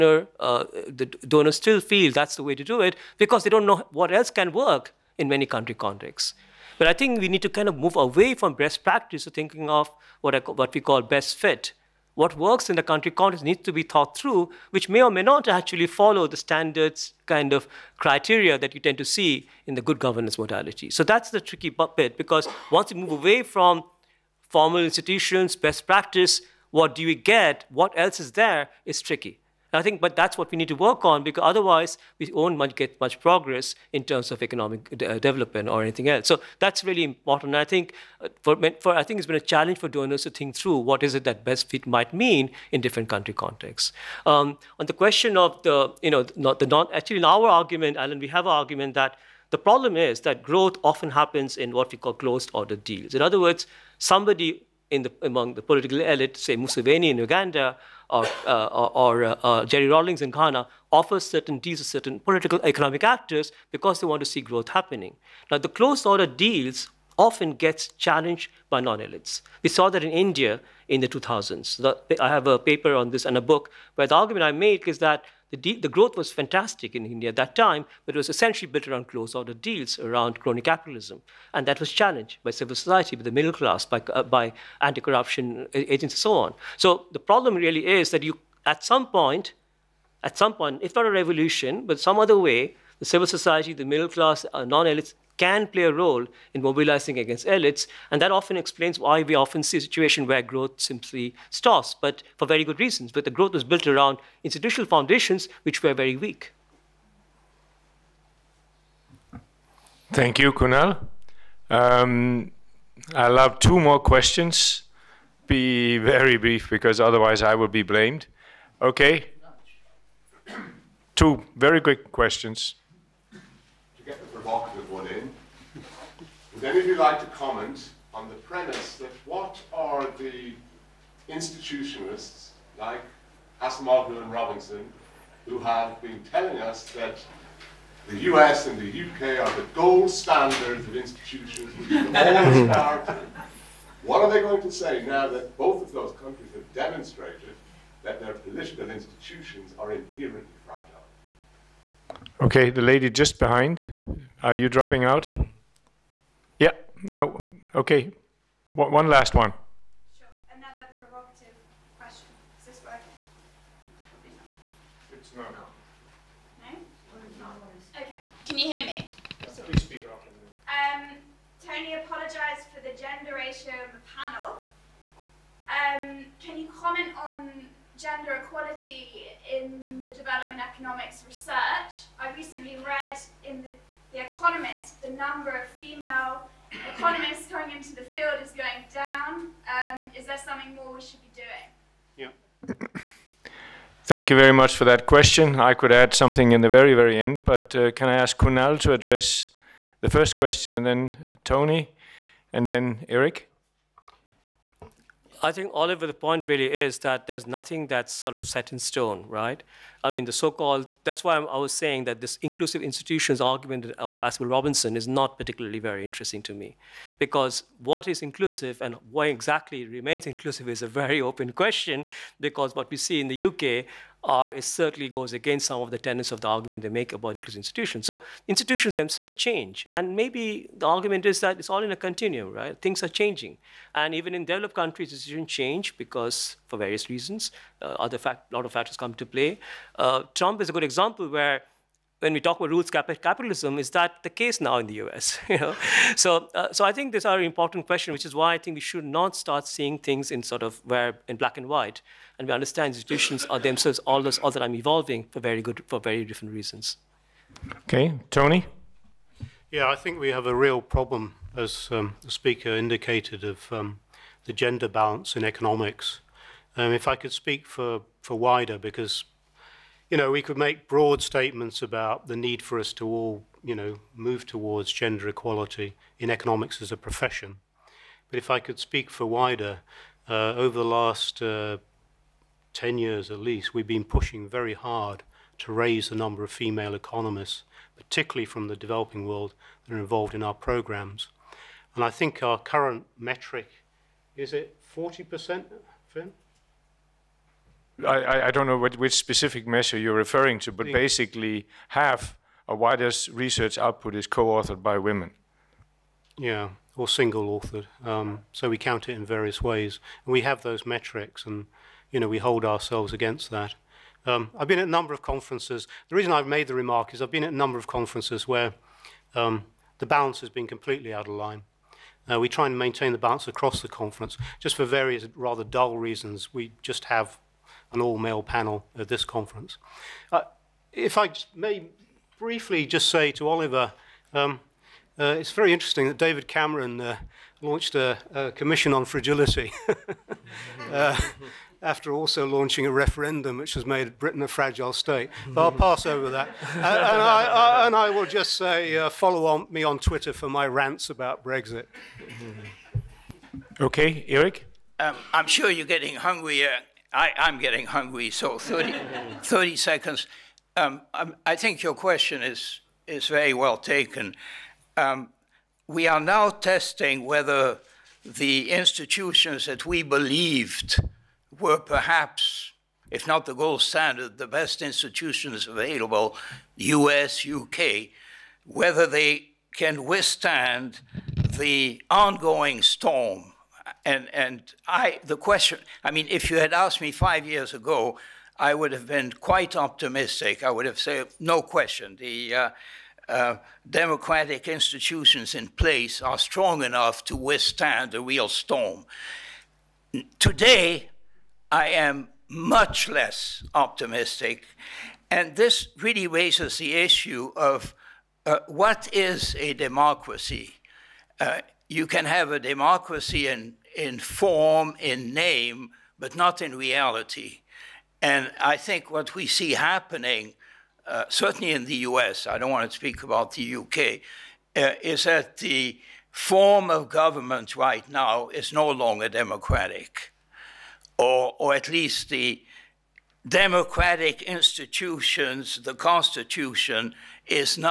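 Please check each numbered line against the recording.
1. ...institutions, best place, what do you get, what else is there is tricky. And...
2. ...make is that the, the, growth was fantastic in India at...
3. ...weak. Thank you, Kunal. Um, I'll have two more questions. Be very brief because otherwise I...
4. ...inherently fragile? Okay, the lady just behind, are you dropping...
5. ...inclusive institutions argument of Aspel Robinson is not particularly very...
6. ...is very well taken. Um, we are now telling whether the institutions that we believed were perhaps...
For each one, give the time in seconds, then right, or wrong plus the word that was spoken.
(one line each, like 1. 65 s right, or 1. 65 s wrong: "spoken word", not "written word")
1. 24 s wrong: "practice", not "place"
2. 74 s right
3. 106 s right
4. 149 s right
5. 212 s right
6. 363 s wrong: "testing", not "telling".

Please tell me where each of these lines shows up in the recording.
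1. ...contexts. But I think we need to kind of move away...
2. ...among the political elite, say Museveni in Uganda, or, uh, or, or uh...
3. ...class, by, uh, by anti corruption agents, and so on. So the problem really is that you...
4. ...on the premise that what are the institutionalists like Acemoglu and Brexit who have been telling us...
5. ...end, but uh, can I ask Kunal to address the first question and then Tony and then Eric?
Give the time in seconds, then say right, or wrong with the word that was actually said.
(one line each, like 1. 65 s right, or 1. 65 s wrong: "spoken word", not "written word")
1. 5 s right
2. 55 s right
3. 83 s right
4. 128 s wrong: "Robinson", not "Brexit"
5. 197 s right.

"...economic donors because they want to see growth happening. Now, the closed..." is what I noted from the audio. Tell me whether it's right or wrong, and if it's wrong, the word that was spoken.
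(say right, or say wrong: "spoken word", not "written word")
wrong: "actors", not "donors".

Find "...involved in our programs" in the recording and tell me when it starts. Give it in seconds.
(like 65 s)
289 s.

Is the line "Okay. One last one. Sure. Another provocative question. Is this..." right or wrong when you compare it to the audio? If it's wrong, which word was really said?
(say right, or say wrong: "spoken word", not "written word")
right.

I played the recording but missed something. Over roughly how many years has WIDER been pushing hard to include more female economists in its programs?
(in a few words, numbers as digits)
10 years.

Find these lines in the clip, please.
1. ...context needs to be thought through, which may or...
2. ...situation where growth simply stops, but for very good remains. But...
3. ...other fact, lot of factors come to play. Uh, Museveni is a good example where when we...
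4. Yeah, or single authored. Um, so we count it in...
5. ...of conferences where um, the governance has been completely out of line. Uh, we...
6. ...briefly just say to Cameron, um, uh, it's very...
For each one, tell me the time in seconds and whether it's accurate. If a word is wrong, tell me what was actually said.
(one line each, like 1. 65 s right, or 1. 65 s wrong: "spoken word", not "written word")
1. 13 s right
2. 99 s wrong: "reasons", not "remains"
3. 237 s wrong: "Trump", not "Museveni"
4. 306 s right
5. 317 s wrong: "balance", not "governance"
6. 332 s wrong: "Oliver", not "Cameron".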